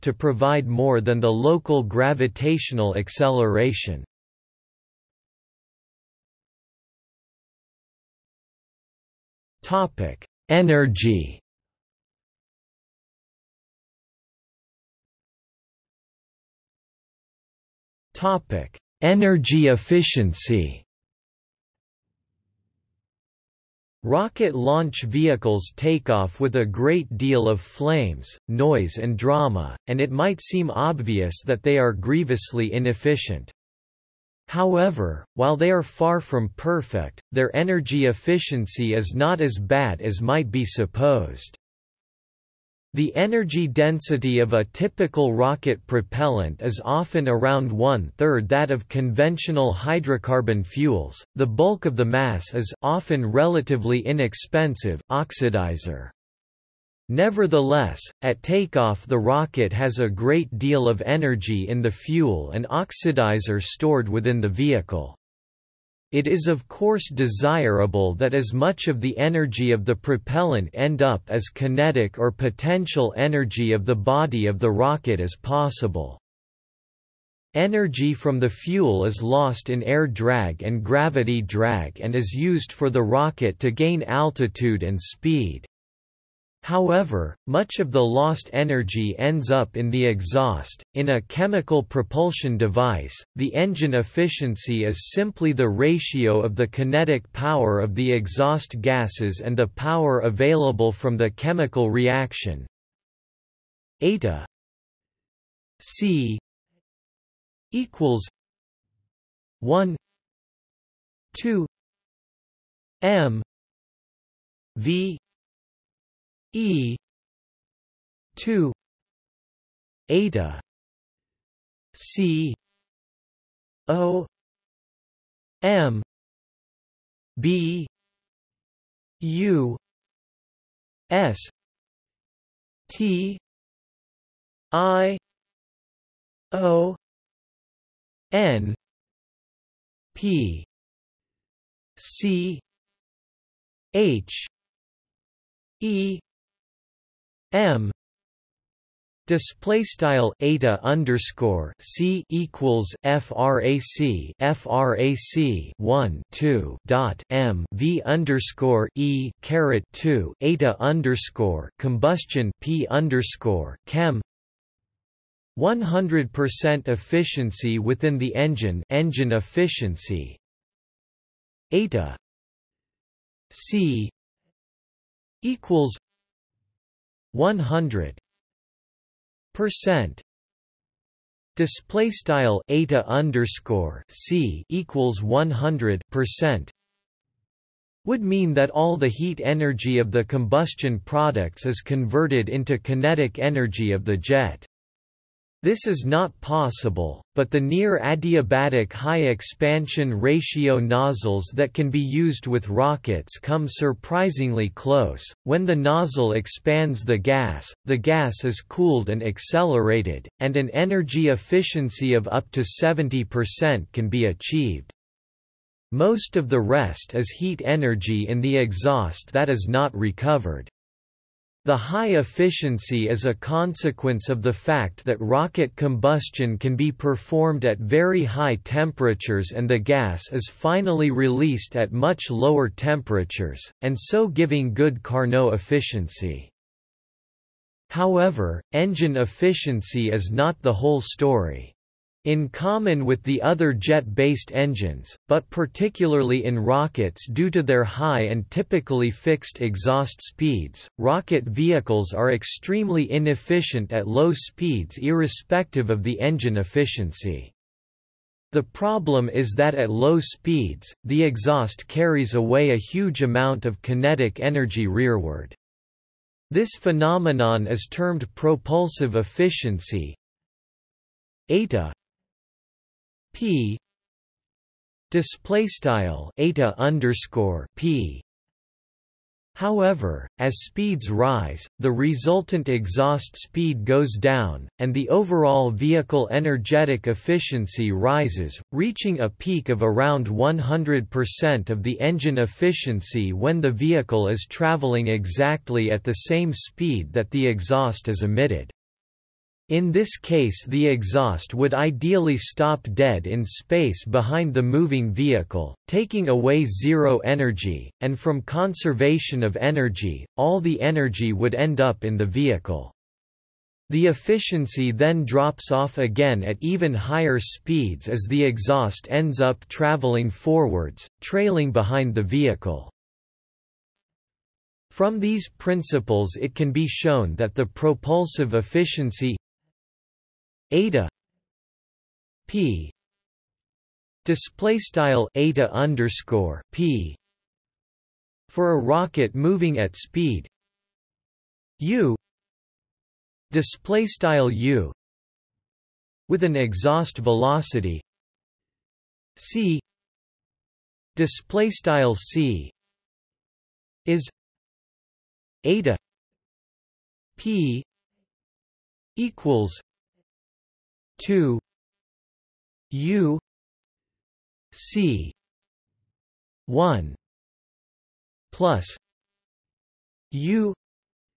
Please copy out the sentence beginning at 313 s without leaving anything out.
The efficiency then drops off again at even higher speeds as the exhaust ends up traveling forwards, trailing behind the vehicle.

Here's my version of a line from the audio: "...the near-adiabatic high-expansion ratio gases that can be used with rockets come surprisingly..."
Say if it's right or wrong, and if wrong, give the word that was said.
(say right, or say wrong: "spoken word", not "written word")
wrong: "nozzles", not "gases".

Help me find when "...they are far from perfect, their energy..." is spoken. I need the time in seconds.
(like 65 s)
35 s.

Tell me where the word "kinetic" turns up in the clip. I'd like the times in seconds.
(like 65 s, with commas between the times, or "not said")
71 s, 96 s, 192 s, 263 s.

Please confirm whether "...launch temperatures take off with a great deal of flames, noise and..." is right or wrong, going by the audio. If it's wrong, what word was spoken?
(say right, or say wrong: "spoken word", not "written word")
wrong: "vehicles", not "temperatures".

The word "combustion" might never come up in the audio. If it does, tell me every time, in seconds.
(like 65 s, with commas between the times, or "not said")
161 s, 190 s, 225 s.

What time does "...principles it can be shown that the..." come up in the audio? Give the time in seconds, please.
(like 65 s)
325 s.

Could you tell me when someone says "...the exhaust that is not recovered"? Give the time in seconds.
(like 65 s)
218 s.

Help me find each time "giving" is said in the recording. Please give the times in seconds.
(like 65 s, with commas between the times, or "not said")
234 s.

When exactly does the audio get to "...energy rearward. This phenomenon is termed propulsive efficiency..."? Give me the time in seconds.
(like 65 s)
264 s.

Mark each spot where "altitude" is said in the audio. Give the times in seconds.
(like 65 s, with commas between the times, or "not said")
84 s.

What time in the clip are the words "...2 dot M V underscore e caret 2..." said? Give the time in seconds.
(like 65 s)
156 s.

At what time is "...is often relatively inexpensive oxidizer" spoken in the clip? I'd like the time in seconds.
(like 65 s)
52 s.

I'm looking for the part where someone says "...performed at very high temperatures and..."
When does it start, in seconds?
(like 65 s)
226 s.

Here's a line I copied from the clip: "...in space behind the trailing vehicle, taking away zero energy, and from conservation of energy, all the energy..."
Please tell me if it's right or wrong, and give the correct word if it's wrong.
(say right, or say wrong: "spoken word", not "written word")
wrong: "moving", not "trailing".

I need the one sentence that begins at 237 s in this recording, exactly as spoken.
However, engine efficiency is not the whole story.